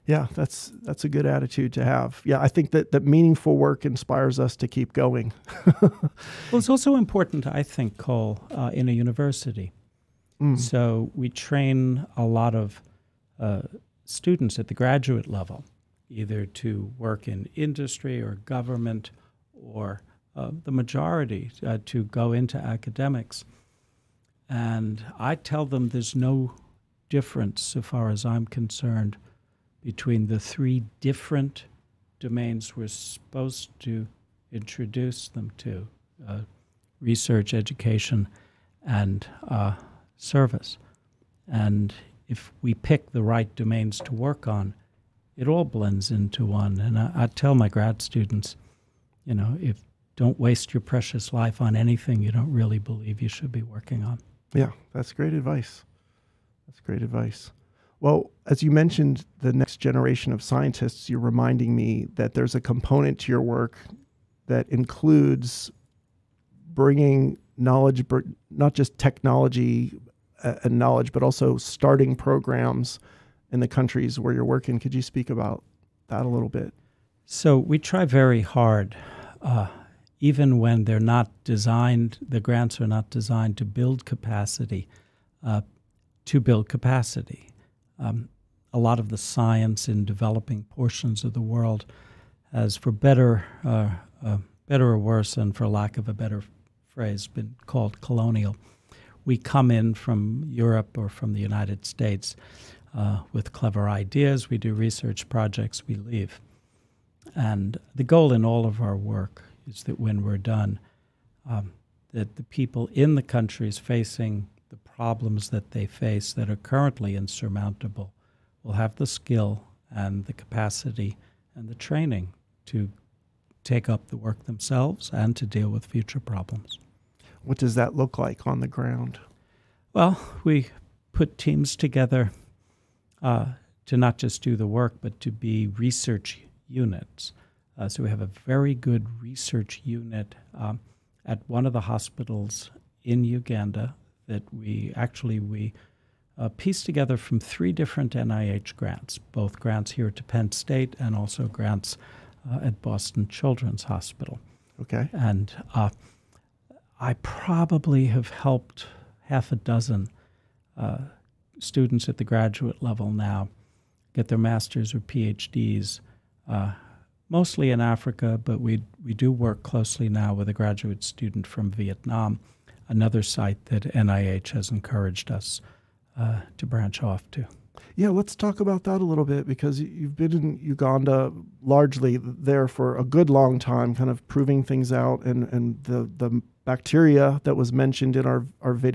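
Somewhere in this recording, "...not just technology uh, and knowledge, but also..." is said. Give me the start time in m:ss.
1:08.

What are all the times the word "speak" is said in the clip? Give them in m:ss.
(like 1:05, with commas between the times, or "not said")
1:15.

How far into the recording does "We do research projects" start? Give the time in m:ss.
1:44.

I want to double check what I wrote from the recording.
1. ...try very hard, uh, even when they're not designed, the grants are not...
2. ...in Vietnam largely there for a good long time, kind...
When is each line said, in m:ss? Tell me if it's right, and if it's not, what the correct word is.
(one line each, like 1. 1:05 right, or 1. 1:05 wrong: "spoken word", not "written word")
1. 1:17 right
2. 3:00 wrong: "Uganda", not "Vietnam".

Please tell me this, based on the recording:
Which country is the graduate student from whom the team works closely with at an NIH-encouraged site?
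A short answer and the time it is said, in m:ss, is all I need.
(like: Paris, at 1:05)
Vietnam, at 2:51.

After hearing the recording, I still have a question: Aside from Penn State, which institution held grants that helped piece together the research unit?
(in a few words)
Boston Children's Hospital.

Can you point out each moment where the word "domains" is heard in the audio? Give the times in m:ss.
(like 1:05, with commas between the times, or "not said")
0:32, 0:43.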